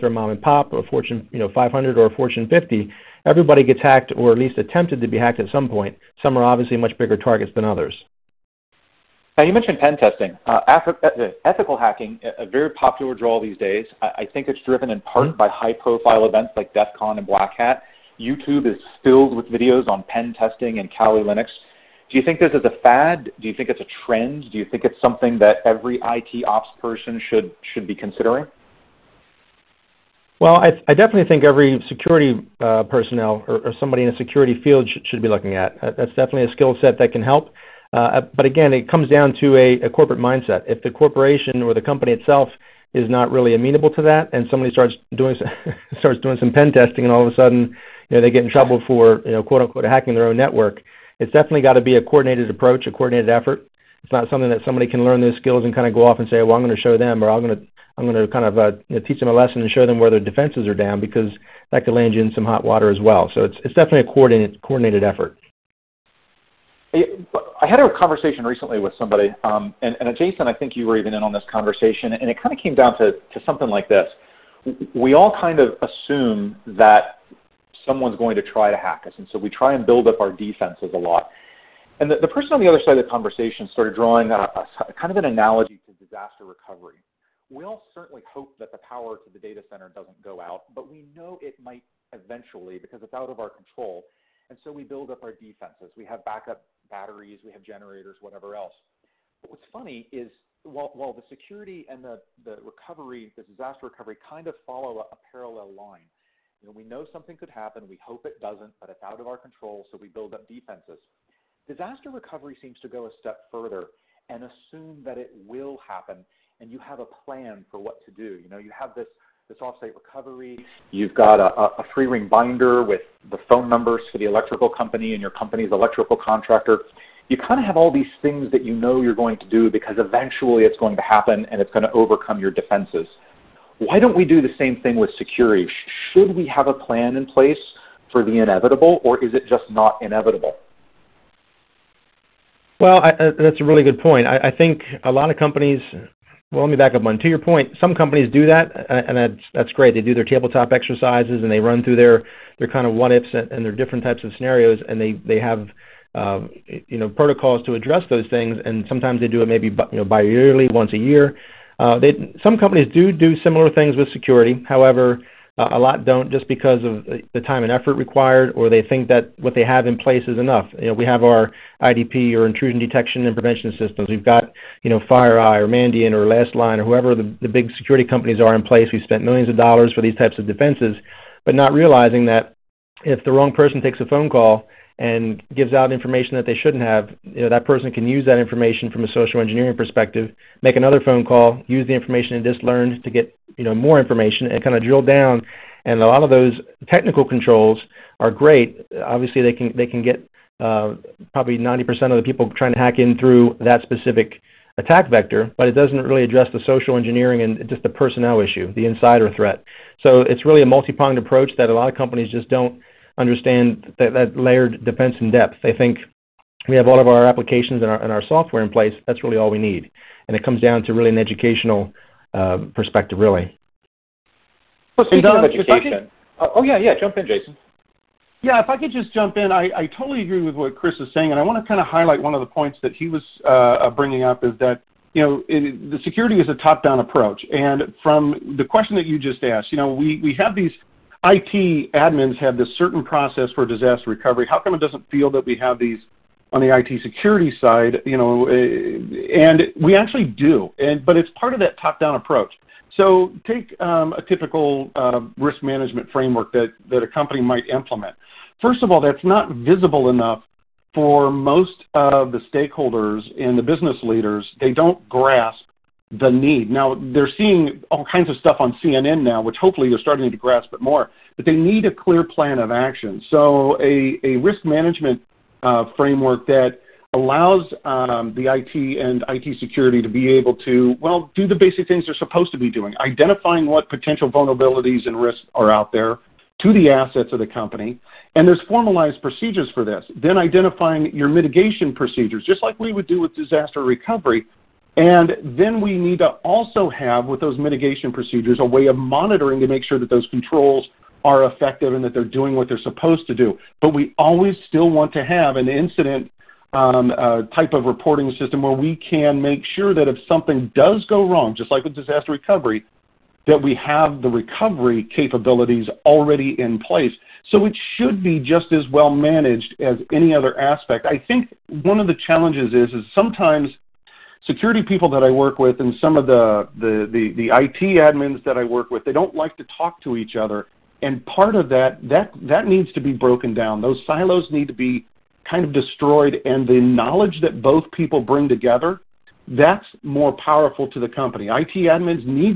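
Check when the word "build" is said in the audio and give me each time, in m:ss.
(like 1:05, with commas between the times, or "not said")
1:19, 1:34, 1:50.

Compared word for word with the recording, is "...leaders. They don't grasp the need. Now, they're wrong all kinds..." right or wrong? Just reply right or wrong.
wrong.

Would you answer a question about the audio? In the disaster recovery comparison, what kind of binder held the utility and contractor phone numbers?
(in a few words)
free ring binder.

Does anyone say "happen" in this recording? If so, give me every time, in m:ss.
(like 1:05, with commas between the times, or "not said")
1:47, 1:55, 2:11.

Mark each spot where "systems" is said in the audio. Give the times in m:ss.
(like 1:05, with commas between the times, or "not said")
2:53, 5:08.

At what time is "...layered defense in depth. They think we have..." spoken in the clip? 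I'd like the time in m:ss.
3:34.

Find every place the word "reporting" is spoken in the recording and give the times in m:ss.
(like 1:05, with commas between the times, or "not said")
5:07.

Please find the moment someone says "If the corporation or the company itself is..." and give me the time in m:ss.
0:40.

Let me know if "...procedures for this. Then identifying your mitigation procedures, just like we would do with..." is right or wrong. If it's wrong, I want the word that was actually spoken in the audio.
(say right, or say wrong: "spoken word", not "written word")
right.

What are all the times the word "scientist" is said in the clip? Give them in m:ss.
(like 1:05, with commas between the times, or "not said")
not said.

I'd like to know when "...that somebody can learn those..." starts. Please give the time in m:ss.
0:54.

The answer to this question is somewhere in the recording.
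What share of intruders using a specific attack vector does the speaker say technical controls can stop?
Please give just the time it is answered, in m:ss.
3:21.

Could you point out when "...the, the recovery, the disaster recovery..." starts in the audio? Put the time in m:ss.
1:42.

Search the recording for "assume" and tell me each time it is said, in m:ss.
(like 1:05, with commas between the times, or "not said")
1:15, 1:54.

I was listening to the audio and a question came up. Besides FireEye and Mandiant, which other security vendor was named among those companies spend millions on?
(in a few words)
LastLine.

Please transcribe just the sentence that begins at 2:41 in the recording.
Uh, they, some companies do do similar things with security.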